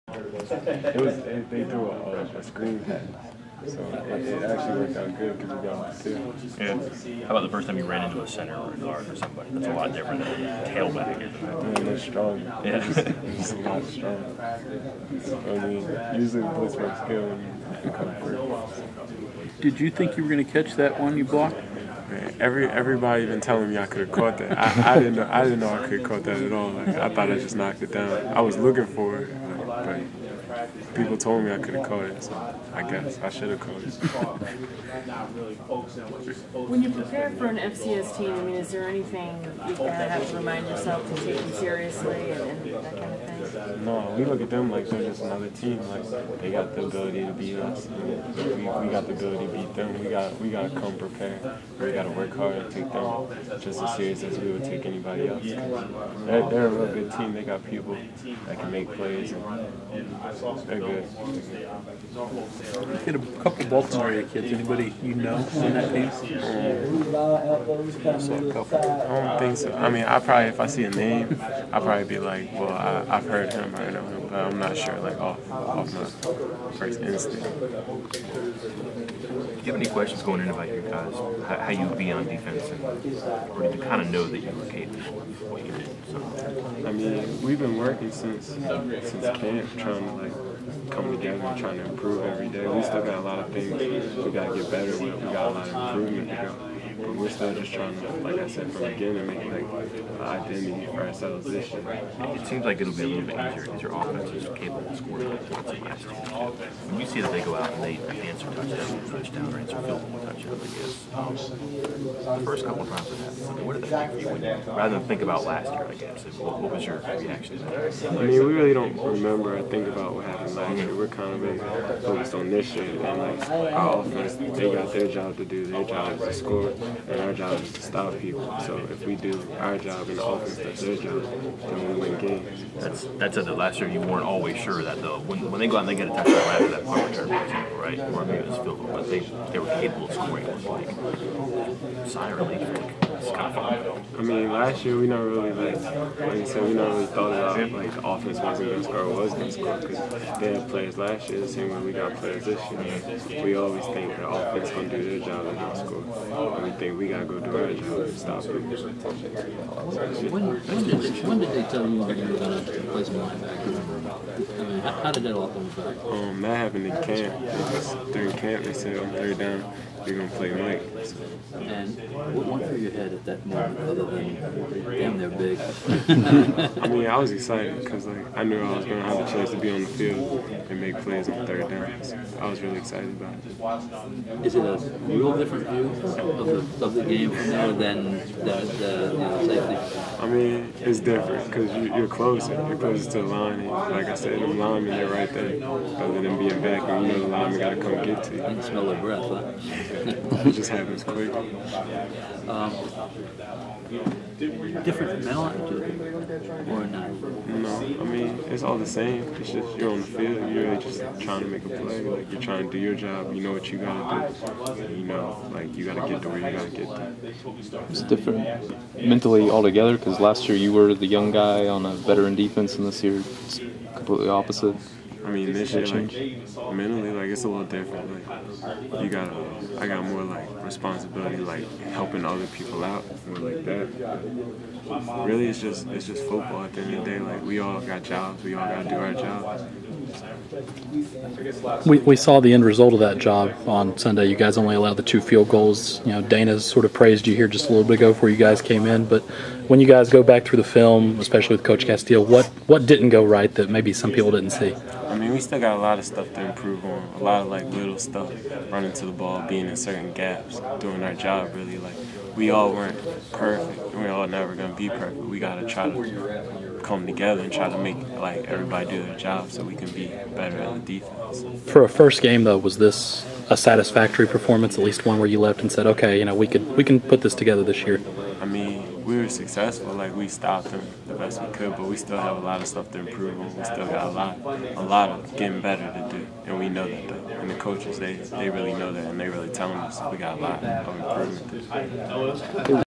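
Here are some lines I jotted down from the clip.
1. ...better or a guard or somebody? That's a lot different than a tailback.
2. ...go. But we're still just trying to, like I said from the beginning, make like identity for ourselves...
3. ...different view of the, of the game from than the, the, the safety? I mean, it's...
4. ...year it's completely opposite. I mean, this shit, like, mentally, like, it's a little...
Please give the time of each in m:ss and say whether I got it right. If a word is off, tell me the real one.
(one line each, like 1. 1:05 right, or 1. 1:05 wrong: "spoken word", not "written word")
1. 0:08 wrong: "center", not "better"
2. 1:36 right
3. 3:05 right
4. 3:43 right.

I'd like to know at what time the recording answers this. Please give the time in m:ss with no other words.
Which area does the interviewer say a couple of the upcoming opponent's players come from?
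1:03.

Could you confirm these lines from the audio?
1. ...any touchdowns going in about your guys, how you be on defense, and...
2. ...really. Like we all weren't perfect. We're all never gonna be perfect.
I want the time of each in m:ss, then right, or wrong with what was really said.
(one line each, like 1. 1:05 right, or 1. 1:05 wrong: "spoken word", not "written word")
1. 1:19 wrong: "questions", not "touchdowns"
2. 4:21 right.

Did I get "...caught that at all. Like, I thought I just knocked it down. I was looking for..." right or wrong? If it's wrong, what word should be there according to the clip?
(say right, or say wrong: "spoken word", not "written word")
right.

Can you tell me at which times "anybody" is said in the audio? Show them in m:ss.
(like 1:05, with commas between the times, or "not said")
0:54, 1:04.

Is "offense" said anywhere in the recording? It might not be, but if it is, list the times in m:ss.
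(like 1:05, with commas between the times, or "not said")
1:43, 2:03, 2:10, 2:28, 2:34.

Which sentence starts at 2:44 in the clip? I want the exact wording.
I mean, how, how did that all come about?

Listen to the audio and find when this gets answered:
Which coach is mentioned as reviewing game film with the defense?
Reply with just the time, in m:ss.
4:11.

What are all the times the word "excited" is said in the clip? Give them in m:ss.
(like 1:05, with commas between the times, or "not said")
2:57, 3:02.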